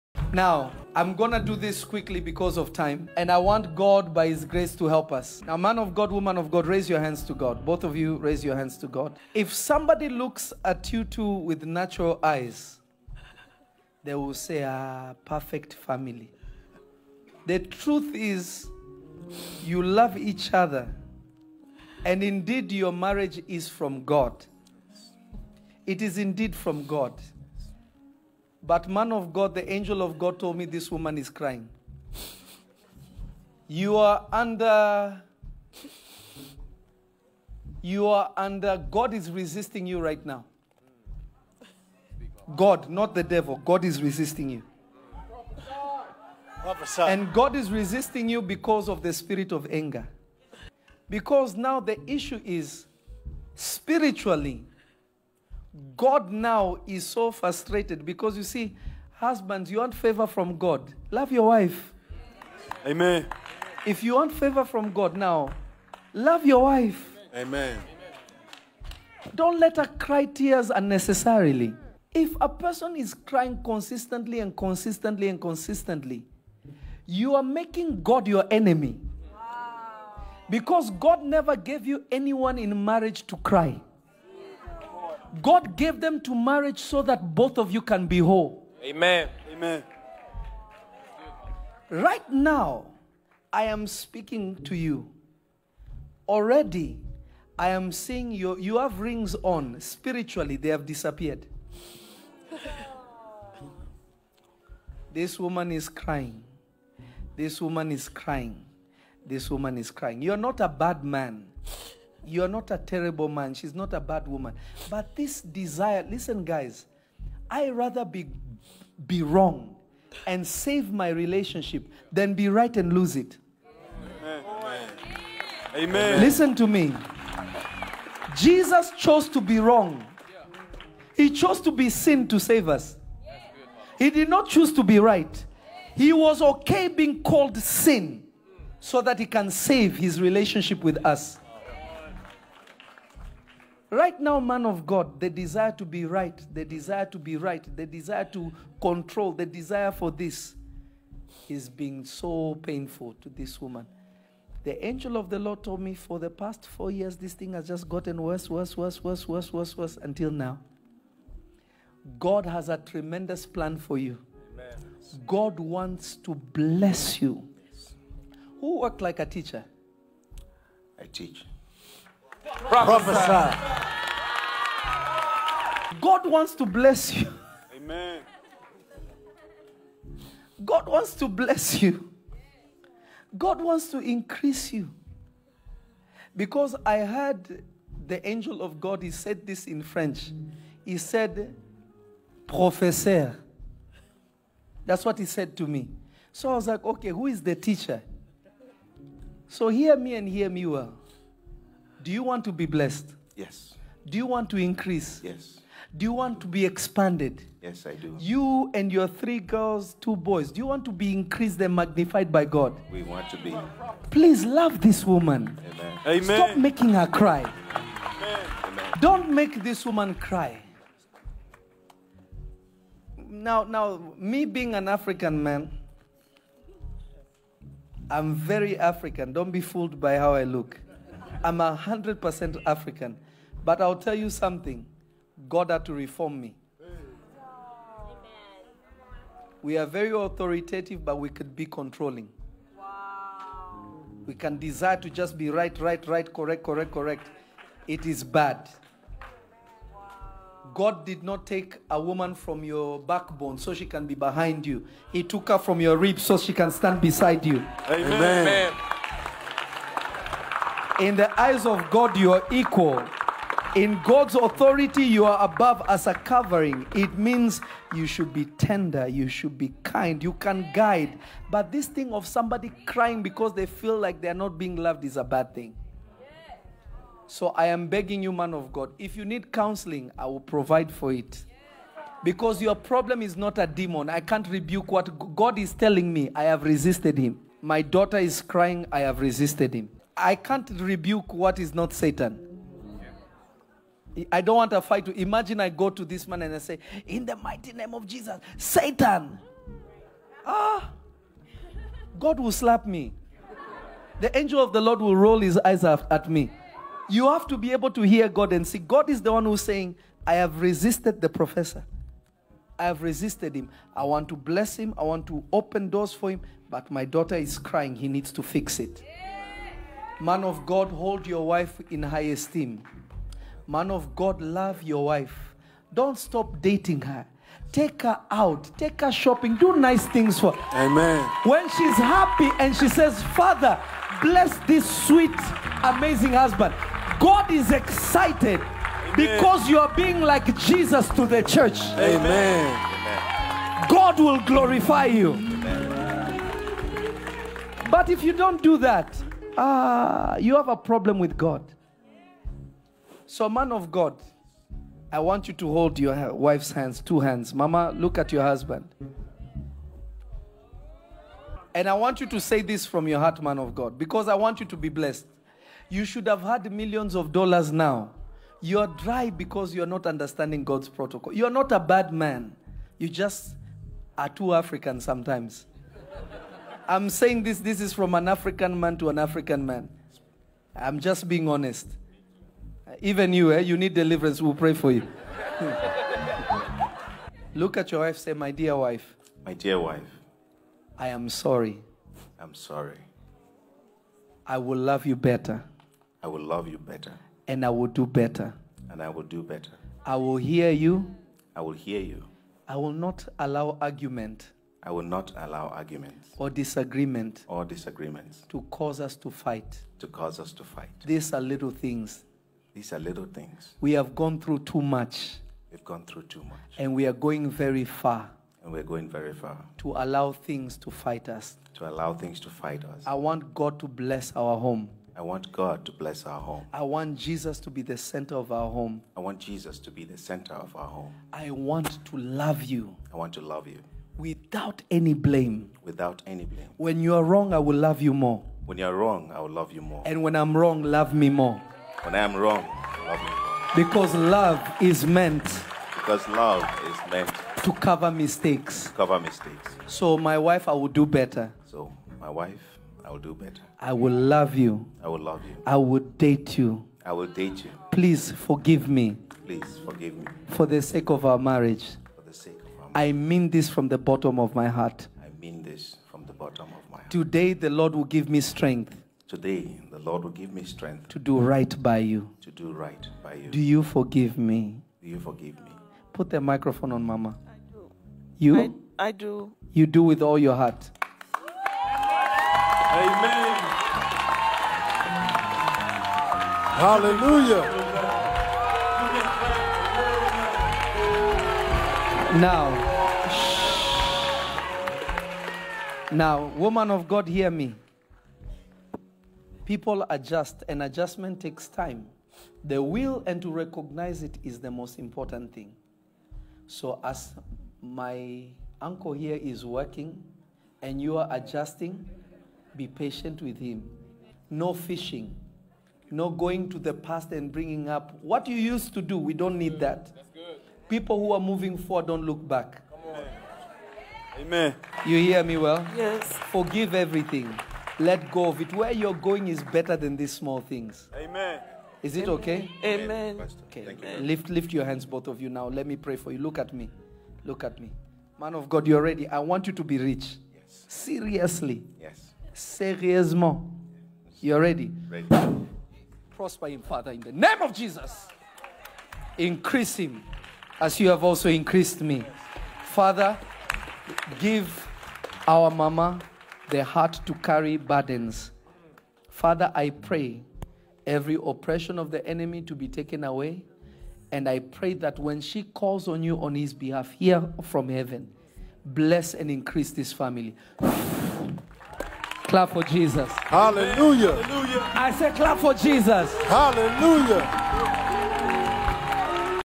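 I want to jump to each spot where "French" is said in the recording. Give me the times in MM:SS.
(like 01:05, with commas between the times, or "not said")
03:09.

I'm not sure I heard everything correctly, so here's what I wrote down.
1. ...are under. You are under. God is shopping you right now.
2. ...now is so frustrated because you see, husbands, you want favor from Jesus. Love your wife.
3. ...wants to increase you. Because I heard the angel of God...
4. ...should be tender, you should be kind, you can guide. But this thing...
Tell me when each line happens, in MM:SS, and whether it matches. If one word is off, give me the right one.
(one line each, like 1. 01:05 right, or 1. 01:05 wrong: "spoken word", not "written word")
1. 00:33 wrong: "resisting", not "shopping"
2. 00:56 wrong: "God", not "Jesus"
3. 03:03 right
4. 04:28 right.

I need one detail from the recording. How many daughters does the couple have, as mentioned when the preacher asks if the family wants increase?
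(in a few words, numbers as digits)
3.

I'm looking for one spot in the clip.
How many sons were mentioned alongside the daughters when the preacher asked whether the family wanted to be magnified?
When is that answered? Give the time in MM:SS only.
03:30.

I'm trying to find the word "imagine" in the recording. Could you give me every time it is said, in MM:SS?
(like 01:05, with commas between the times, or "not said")
04:55.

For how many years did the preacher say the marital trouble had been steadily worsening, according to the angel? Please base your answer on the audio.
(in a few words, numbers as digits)
4.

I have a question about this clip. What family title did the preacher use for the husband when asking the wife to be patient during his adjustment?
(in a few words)
Uncle.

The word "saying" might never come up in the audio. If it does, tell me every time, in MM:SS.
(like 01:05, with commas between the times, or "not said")
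05:09, 06:17.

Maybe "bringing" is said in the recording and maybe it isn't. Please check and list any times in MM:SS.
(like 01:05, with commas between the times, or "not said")
08:37.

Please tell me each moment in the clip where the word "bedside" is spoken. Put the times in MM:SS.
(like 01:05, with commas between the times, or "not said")
not said.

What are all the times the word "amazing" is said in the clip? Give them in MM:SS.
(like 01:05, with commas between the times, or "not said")
05:35.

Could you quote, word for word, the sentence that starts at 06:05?
You should have had millions of dollars now.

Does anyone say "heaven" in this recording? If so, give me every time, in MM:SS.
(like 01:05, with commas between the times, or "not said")
09:27.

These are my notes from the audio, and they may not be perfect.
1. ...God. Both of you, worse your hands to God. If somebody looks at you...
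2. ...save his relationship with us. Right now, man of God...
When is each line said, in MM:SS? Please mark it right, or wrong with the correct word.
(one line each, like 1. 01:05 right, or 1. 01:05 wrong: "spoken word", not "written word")
1. 00:07 wrong: "raise", not "worse"
2. 02:19 right.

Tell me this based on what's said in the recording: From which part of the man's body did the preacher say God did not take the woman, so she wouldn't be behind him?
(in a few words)
Backbone.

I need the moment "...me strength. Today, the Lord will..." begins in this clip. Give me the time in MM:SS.
07:48.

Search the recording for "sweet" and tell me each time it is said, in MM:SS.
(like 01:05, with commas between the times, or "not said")
05:35.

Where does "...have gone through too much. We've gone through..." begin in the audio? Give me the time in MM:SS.
06:53.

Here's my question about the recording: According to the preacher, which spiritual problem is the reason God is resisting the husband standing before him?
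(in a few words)
Spirit of anger.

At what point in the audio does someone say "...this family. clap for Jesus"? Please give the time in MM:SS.
09:29.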